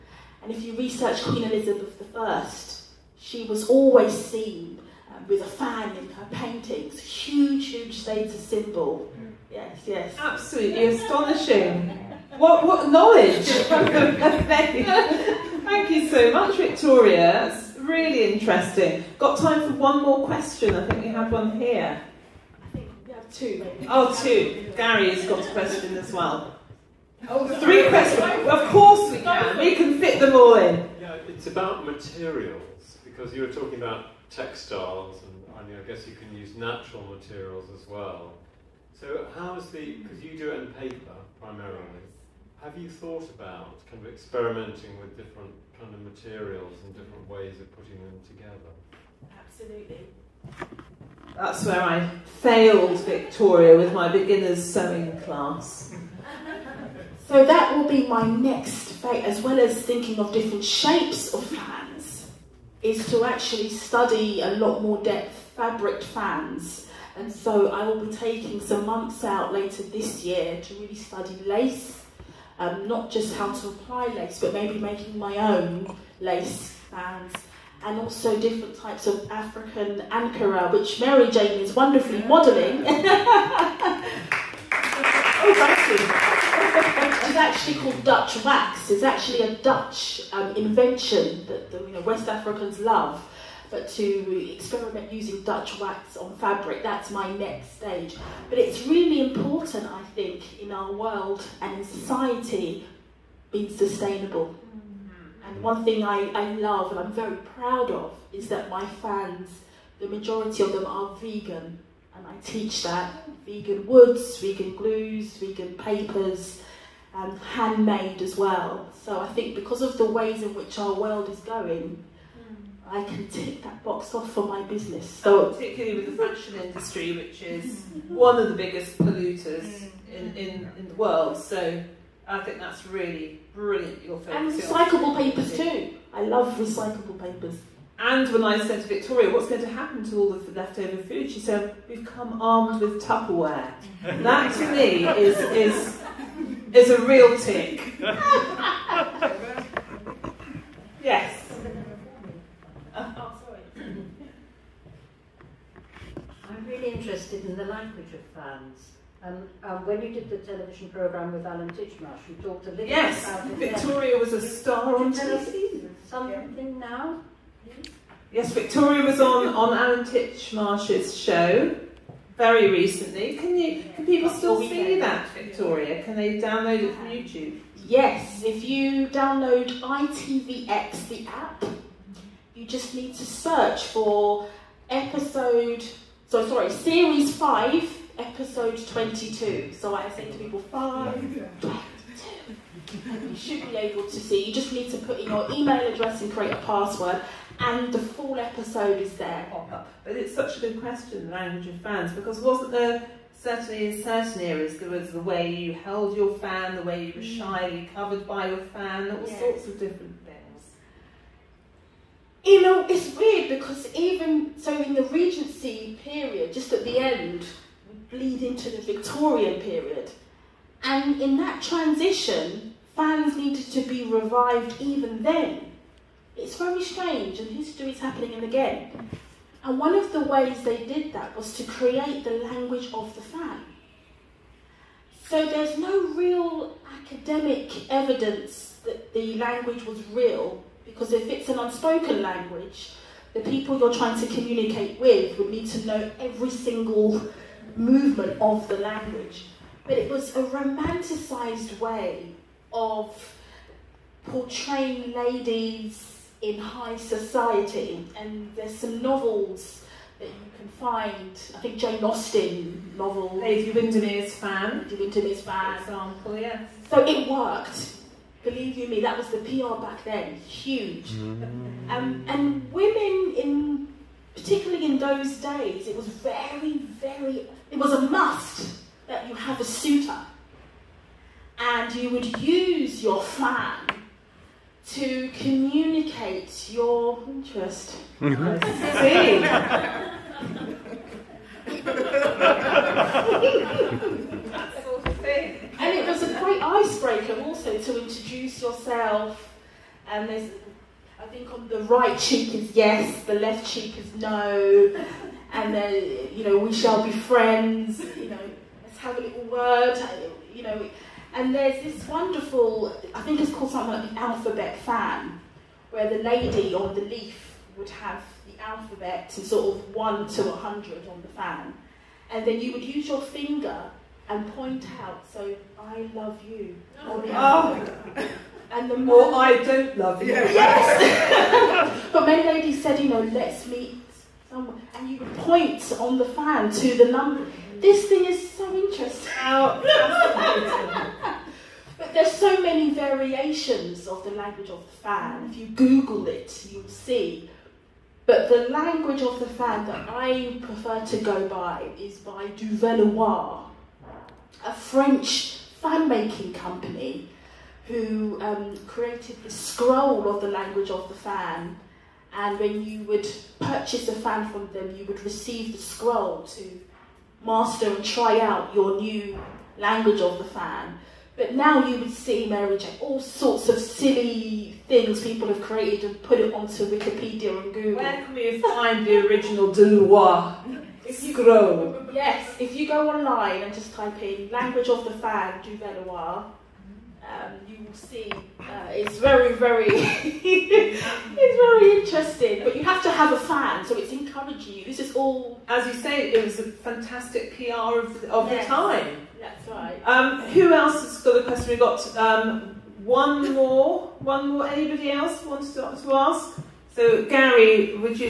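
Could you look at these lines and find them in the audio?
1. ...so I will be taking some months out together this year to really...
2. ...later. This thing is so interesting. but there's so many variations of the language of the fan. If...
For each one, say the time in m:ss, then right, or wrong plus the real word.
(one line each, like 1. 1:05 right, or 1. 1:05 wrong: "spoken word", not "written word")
1. 1:07 wrong: "later", not "together"
2. 5:37 wrong: "number", not "later".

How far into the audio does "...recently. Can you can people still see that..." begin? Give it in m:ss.
2:52.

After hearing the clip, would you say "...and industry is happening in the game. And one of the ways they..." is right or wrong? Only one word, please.
wrong.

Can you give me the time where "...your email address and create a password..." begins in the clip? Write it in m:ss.
3:15.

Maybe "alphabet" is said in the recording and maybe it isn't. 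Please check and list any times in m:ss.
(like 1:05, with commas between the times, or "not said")
5:14, 5:18.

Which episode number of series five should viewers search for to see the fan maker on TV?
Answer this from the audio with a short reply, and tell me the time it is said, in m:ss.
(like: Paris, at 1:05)
22, at 3:08.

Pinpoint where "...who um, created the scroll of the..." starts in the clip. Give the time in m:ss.
5:57.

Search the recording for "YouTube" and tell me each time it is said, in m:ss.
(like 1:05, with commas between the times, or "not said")
2:57.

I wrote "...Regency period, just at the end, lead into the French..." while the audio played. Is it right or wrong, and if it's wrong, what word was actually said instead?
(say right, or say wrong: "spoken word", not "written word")
wrong: "Victorian", not "French".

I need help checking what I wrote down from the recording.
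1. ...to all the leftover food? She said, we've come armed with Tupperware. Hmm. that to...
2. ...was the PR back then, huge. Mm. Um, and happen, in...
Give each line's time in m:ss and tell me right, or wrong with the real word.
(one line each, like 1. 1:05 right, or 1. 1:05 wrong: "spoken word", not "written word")
1. 2:20 right
2. 4:29 wrong: "women", not "happen".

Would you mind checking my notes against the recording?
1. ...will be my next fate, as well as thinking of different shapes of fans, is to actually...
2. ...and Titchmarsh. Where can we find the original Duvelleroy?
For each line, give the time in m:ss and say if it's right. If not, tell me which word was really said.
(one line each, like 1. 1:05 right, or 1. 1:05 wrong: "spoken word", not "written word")
1. 0:57 right
2. 6:17 wrong: "Google", not "Titchmarsh".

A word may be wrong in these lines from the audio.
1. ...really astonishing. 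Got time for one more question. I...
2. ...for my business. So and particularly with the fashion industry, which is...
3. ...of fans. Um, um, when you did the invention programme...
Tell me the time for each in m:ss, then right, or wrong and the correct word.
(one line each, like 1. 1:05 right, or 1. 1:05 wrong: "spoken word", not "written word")
1. 0:17 wrong: "interesting", not "astonishing"
2. 2:04 right
3. 2:38 wrong: "television", not "invention".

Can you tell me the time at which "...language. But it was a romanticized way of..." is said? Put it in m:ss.
4:08.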